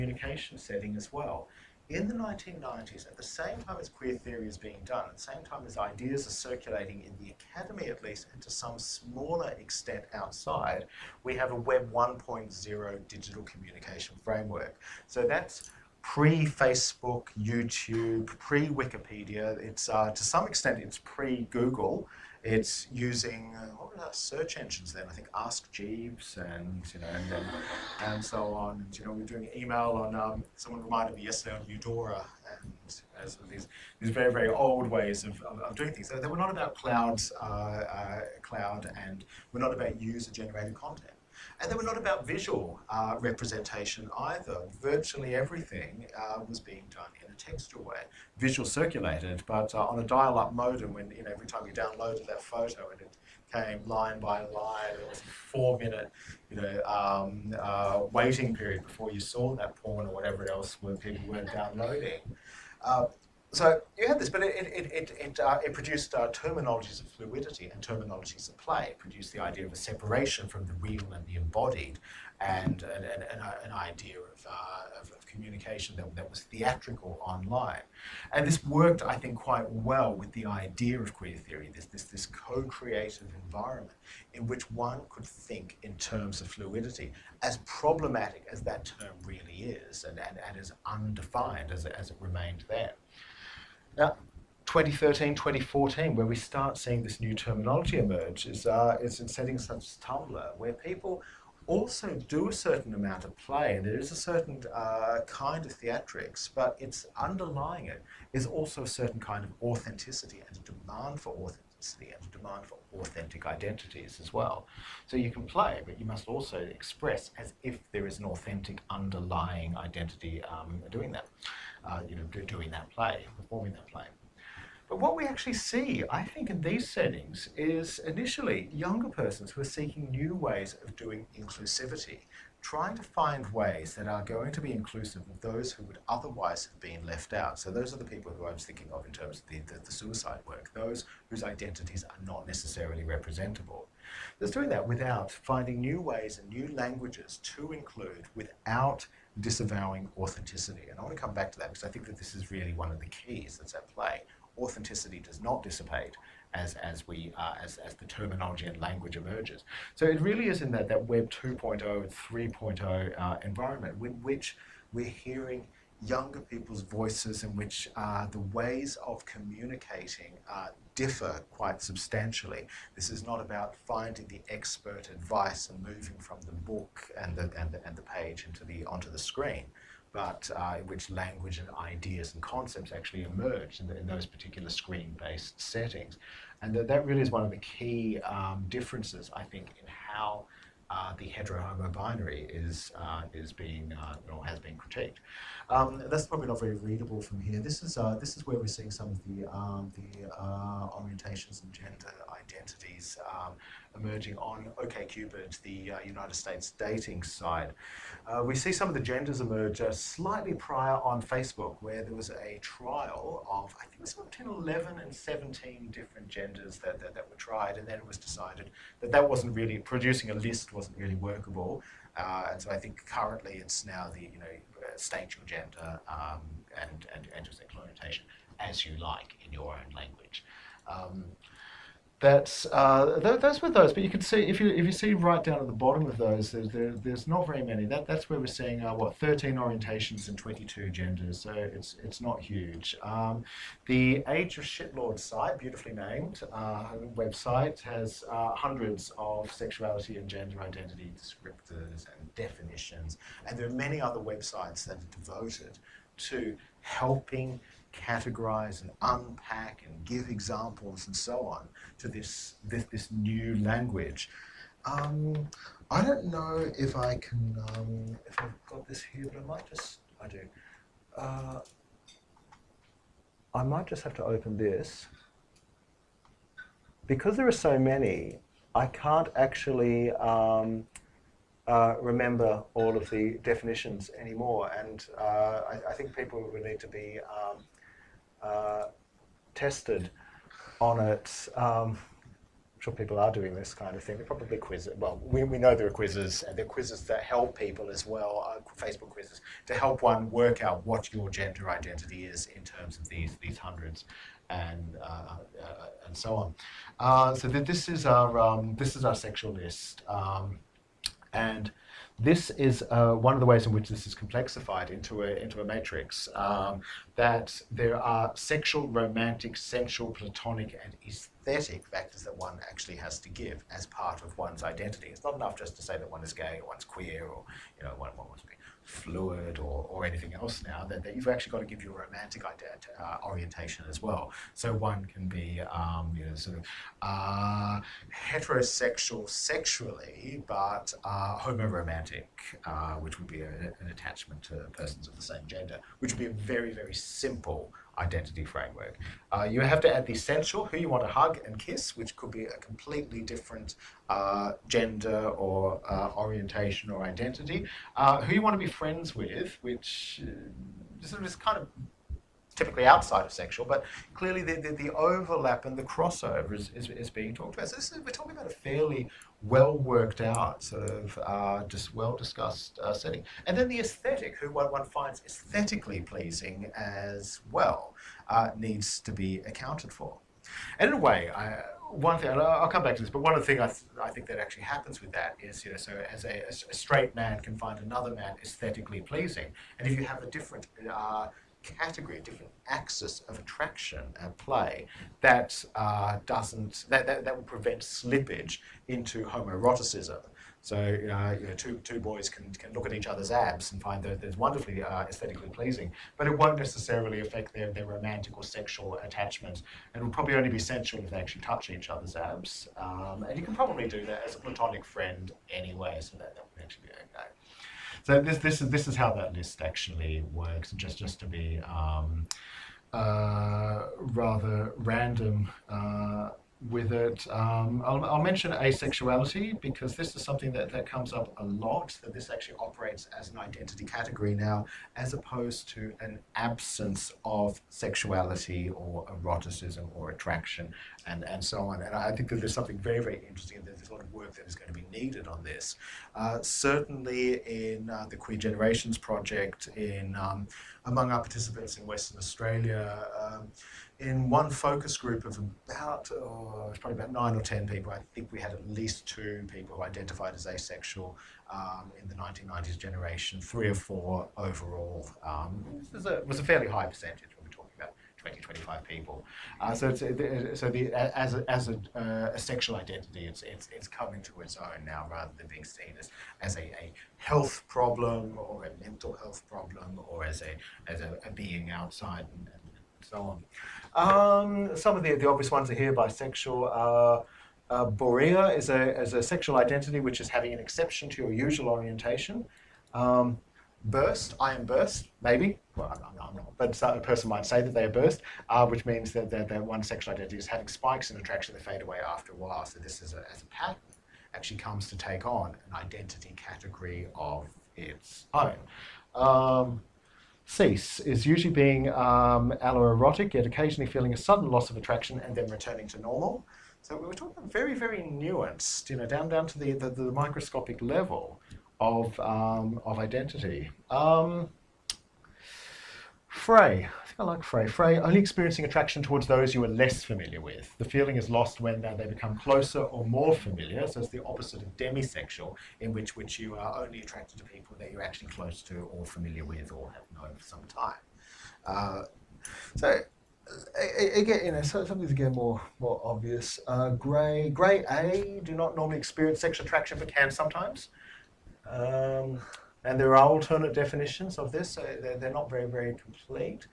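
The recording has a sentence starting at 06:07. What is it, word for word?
So is, we're talking about a fairly well worked out, sort of uh, just well discussed uh, setting.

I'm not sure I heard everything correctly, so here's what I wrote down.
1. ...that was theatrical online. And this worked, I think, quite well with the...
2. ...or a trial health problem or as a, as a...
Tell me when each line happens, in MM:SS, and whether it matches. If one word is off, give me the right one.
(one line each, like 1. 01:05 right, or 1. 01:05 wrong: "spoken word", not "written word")
1. 01:16 right
2. 07:58 wrong: "mental", not "trial".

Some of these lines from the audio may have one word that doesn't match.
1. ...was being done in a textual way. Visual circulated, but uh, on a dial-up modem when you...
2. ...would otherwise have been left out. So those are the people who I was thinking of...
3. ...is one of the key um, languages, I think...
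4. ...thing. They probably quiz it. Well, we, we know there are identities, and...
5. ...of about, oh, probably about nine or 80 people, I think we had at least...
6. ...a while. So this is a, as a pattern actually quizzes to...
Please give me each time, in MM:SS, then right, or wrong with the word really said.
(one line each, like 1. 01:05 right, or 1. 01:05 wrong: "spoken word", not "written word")
1. 00:46 right
2. 02:15 right
3. 03:07 wrong: "differences", not "languages"
4. 04:54 wrong: "quizzes", not "identities"
5. 07:35 wrong: "10", not "80"
6. 08:22 wrong: "comes", not "quizzes".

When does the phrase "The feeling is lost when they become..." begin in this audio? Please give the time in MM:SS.
08:50.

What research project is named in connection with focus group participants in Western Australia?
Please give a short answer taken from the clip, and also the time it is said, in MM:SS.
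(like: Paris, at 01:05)
Queer Generations Project, at 07:28.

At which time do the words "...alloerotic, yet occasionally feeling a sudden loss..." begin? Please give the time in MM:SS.
08:32.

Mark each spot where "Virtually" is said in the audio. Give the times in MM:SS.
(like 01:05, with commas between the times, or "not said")
00:44.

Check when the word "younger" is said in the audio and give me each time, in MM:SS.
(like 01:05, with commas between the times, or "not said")
02:08, 02:46.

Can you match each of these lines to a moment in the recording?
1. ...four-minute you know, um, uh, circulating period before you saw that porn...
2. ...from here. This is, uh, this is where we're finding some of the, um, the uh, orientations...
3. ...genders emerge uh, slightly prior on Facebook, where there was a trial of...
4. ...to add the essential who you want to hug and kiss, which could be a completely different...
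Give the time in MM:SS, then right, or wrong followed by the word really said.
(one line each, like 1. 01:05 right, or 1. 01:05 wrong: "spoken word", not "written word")
1. 00:55 wrong: "waiting", not "circulating"
2. 03:17 wrong: "seeing", not "finding"
3. 03:28 right
4. 05:49 right.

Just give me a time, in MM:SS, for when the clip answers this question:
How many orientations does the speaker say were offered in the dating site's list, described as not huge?
03:59.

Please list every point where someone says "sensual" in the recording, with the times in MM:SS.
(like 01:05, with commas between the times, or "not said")
05:19, 06:50.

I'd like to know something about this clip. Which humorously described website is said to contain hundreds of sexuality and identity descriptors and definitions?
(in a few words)
Age of Shitlord.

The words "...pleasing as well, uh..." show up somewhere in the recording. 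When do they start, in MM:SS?
06:16.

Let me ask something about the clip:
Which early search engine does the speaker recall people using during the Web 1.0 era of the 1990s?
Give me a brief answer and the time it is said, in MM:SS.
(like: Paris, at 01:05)
Ask Jeeves, at 00:25.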